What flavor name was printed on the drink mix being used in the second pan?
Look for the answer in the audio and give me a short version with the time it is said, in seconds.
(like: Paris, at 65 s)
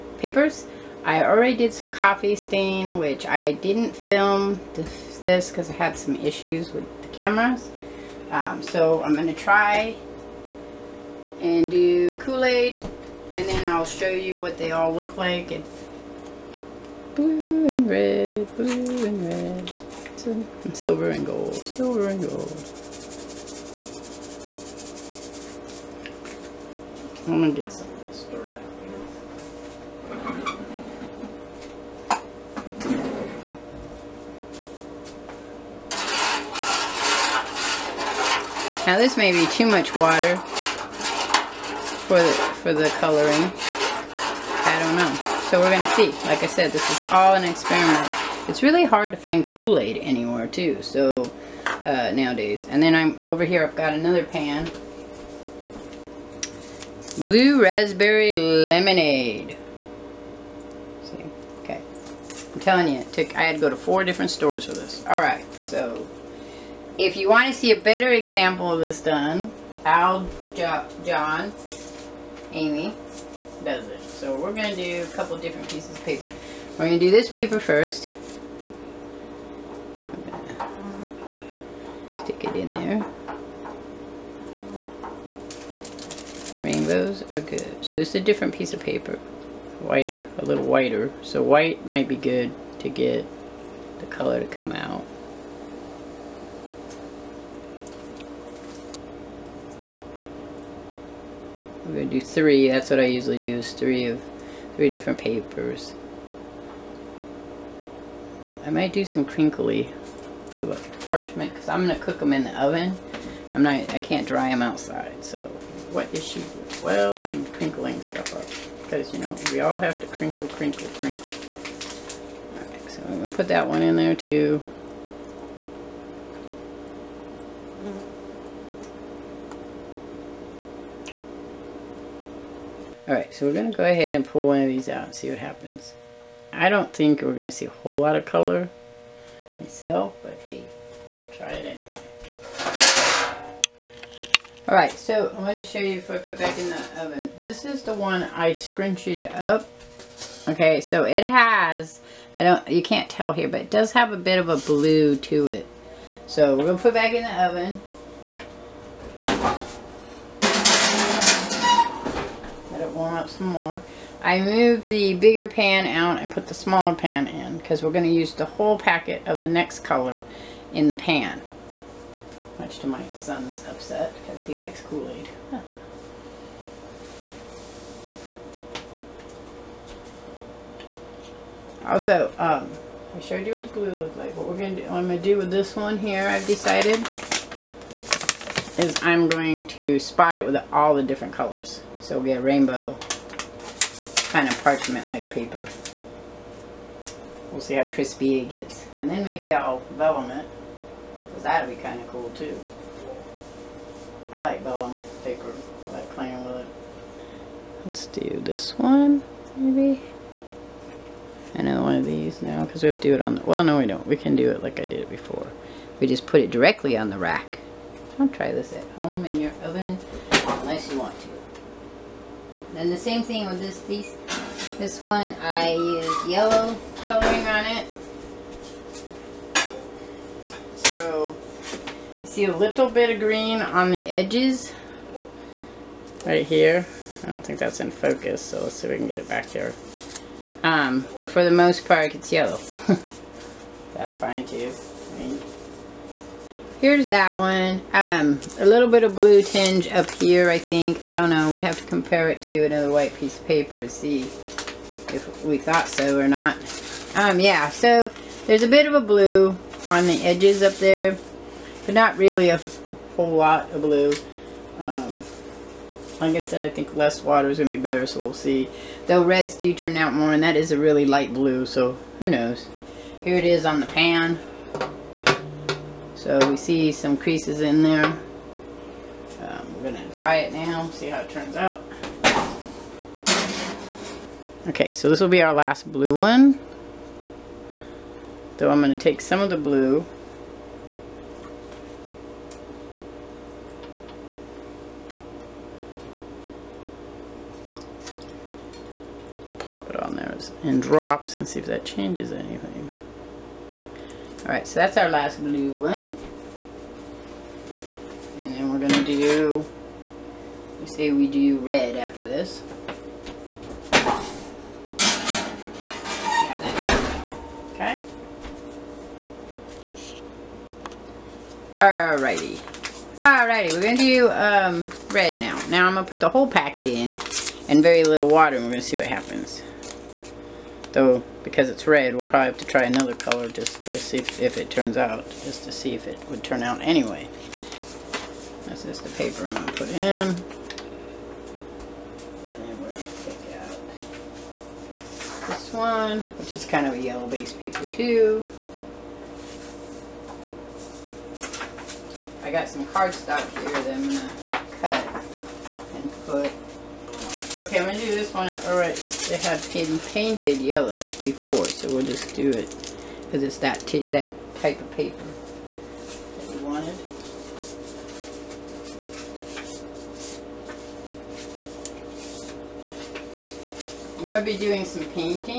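Blue Raspberry Lemonade, at 57 s.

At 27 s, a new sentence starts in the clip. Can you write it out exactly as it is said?
I'm gonna get some of this stirred out Now this may be too much water for the for the coloring.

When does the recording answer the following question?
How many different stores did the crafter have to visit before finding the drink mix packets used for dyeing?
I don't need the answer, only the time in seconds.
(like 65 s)
63 s.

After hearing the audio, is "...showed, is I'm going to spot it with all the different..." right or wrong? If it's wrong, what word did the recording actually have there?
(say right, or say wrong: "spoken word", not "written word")
wrong: "decided", not "showed".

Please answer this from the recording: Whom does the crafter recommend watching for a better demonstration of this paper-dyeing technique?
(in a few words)
John Amy.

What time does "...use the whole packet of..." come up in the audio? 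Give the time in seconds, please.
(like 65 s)
168 s.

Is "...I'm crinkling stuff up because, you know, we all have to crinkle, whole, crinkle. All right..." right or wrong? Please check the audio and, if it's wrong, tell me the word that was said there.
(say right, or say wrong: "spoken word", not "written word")
wrong: "crinkle", not "whole".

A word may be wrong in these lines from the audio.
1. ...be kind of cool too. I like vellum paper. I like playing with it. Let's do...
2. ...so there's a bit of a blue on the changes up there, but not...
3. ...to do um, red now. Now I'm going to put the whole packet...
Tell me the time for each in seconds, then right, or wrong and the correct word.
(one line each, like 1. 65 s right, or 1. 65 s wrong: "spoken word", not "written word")
1. 201 s right
2. 257 s wrong: "edges", not "changes"
3. 323 s right.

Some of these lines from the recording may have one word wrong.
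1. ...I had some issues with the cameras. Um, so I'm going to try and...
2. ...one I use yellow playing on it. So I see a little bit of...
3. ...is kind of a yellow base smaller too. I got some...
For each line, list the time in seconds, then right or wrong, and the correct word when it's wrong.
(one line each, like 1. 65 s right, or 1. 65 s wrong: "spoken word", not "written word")
1. 5 s right
2. 225 s wrong: "coloring", not "playing"
3. 346 s wrong: "paper", not "smaller".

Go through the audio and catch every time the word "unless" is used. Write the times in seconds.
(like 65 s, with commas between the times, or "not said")
220 s.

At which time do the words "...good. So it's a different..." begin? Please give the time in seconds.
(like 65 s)
87 s.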